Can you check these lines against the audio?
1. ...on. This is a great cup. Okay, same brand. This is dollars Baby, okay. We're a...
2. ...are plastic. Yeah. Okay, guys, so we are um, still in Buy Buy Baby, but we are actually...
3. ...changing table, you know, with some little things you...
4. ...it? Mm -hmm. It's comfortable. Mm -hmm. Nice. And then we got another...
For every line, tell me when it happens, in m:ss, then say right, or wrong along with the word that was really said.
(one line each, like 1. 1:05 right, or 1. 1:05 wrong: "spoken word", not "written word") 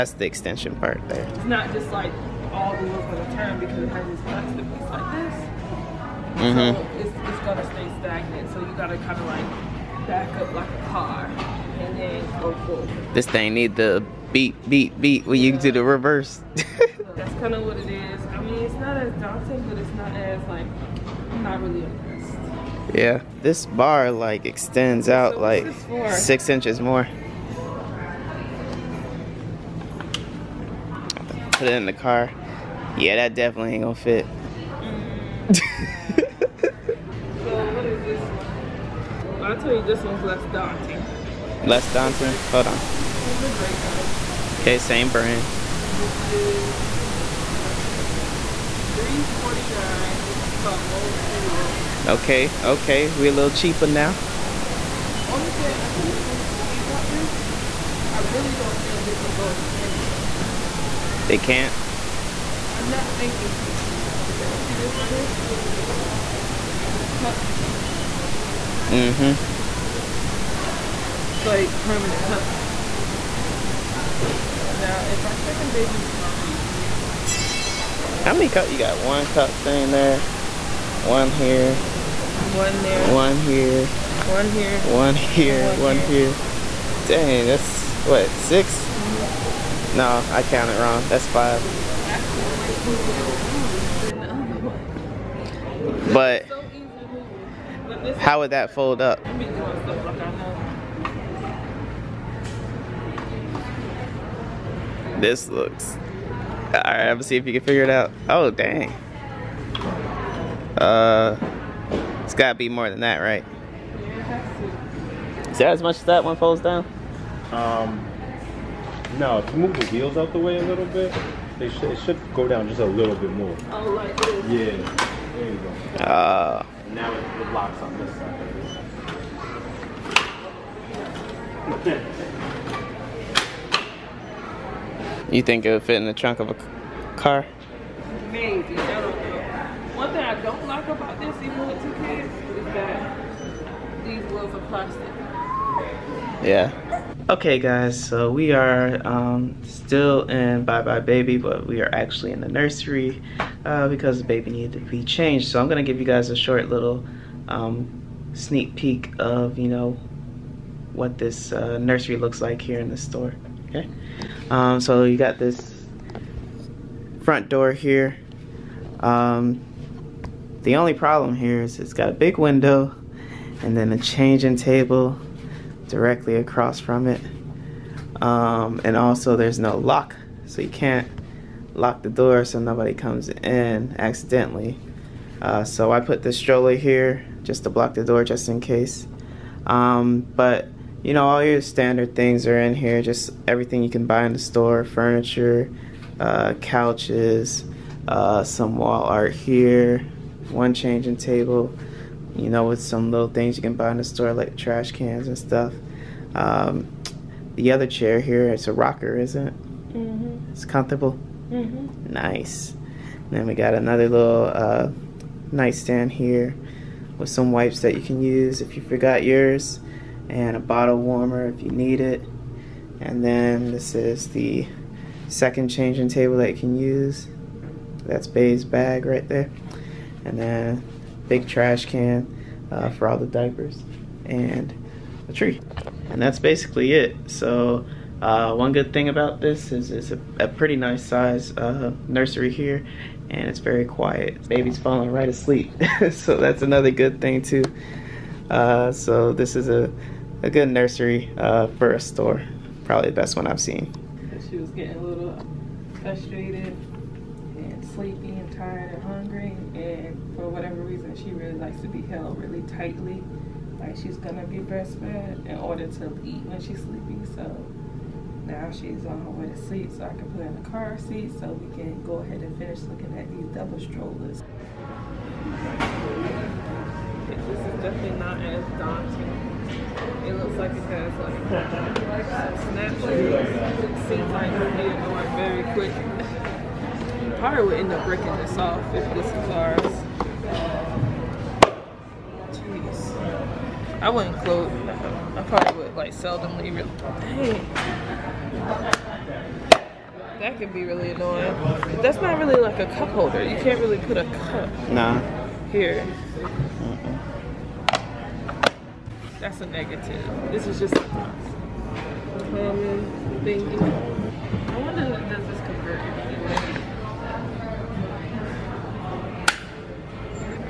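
1. 0:42 wrong: "Okay", not "Baby"
2. 2:24 right
3. 3:20 right
4. 3:29 right.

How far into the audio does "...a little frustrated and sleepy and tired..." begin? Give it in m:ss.
4:14.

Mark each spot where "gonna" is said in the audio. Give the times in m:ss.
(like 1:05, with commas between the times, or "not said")
0:07, 0:33, 1:47, 4:24.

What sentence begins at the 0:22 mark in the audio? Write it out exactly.
Yeah, this bar like extends so out like six inches more.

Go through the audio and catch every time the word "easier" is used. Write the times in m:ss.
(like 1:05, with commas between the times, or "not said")
1:32.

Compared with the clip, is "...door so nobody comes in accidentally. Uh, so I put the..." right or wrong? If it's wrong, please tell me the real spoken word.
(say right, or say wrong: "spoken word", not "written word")
right.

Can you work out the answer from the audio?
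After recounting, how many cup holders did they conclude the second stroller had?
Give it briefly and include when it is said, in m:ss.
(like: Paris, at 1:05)
5, at 1:31.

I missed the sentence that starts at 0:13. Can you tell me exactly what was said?
This thing need the beep, beep, beep when yeah.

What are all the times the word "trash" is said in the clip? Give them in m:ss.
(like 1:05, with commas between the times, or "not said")
3:24, 3:51.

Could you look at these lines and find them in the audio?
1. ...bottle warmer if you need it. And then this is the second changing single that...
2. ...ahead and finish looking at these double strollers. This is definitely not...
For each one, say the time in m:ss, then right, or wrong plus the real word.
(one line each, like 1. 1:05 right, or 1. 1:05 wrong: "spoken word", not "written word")
1. 3:40 wrong: "table", not "single"
2. 4:32 right.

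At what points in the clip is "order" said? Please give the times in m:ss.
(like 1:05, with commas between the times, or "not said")
4:25.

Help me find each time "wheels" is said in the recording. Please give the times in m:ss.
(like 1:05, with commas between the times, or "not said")
1:59, 2:24.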